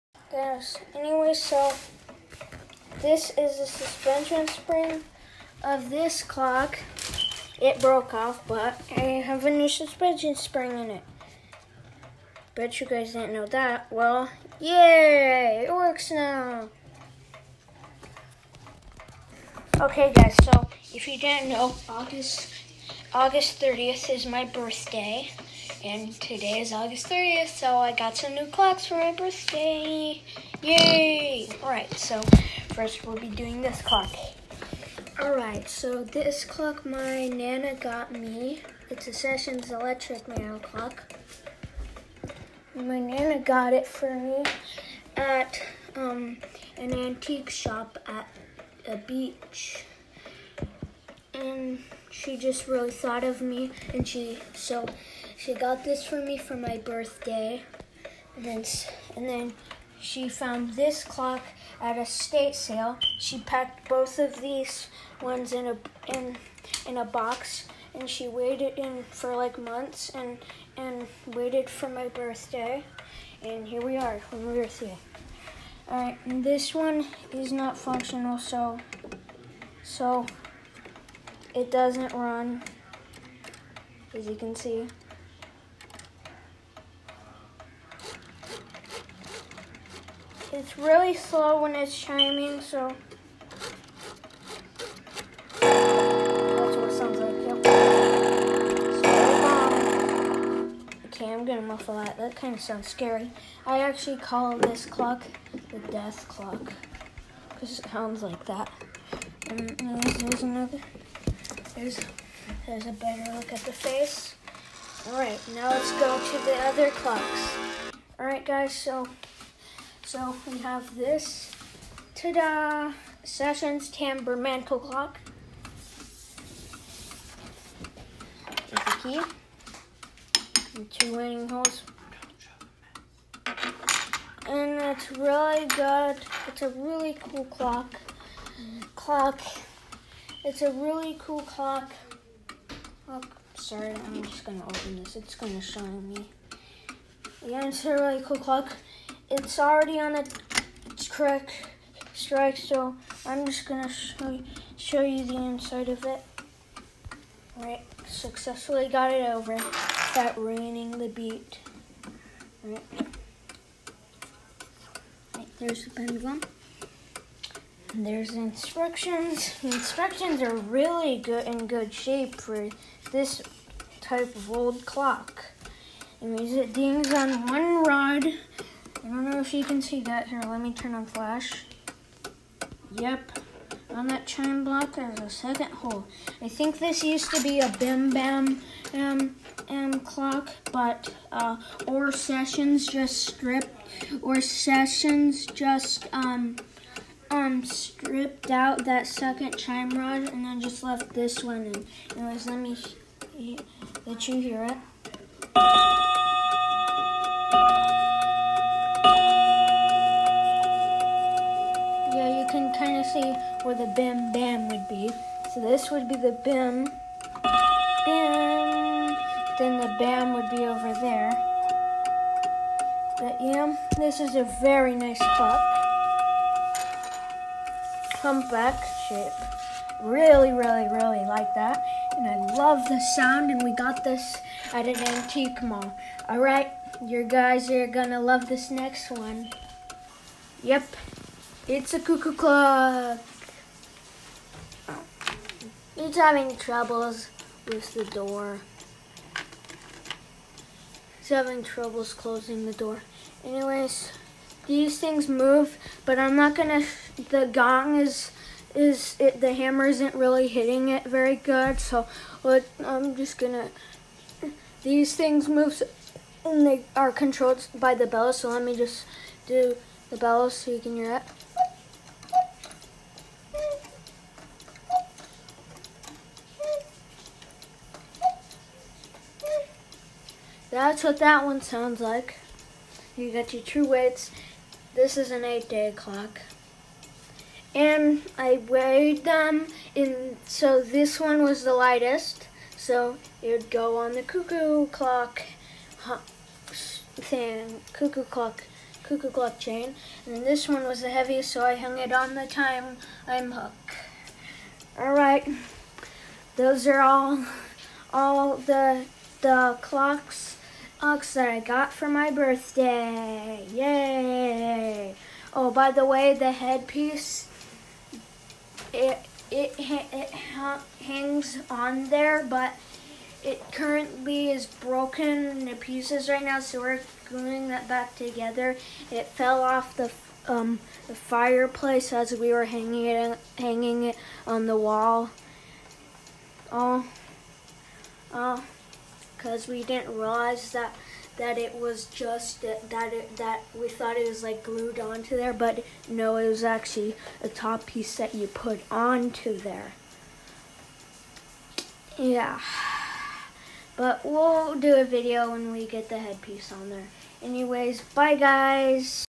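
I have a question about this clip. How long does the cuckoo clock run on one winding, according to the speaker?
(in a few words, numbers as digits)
8 day.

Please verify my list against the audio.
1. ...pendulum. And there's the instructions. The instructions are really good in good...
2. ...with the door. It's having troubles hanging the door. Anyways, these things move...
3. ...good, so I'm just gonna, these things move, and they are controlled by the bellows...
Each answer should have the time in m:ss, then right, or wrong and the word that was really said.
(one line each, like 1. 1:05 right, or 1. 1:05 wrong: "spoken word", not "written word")
1. 2:45 right
2. 4:07 wrong: "closing", not "hanging"
3. 4:21 right.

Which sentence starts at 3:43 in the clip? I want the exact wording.
But yeah, this is a very nice clock.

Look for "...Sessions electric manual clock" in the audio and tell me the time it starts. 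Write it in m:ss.
0:39.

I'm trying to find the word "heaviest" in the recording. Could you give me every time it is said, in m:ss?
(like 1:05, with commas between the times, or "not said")
5:01.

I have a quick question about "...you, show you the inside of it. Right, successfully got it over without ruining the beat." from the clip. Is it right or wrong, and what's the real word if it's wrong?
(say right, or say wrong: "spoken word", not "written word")
right.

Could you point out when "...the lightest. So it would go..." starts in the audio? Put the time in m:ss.
4:51.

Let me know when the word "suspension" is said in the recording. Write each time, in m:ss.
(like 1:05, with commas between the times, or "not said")
0:03, 0:09.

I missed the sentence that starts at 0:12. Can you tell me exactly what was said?
Bet you guys didn't know that.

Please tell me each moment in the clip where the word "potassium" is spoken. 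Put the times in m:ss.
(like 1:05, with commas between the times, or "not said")
not said.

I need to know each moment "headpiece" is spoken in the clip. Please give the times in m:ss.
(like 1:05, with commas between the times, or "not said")
5:16, 5:56.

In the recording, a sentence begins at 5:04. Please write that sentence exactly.
All right, those are all, all the, the clocks Ox that I got for my birthday.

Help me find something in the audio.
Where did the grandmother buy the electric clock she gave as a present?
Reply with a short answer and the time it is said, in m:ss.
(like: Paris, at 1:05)
an antique shop at a beach, at 0:46.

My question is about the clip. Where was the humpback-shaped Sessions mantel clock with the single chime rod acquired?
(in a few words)
an antique mall.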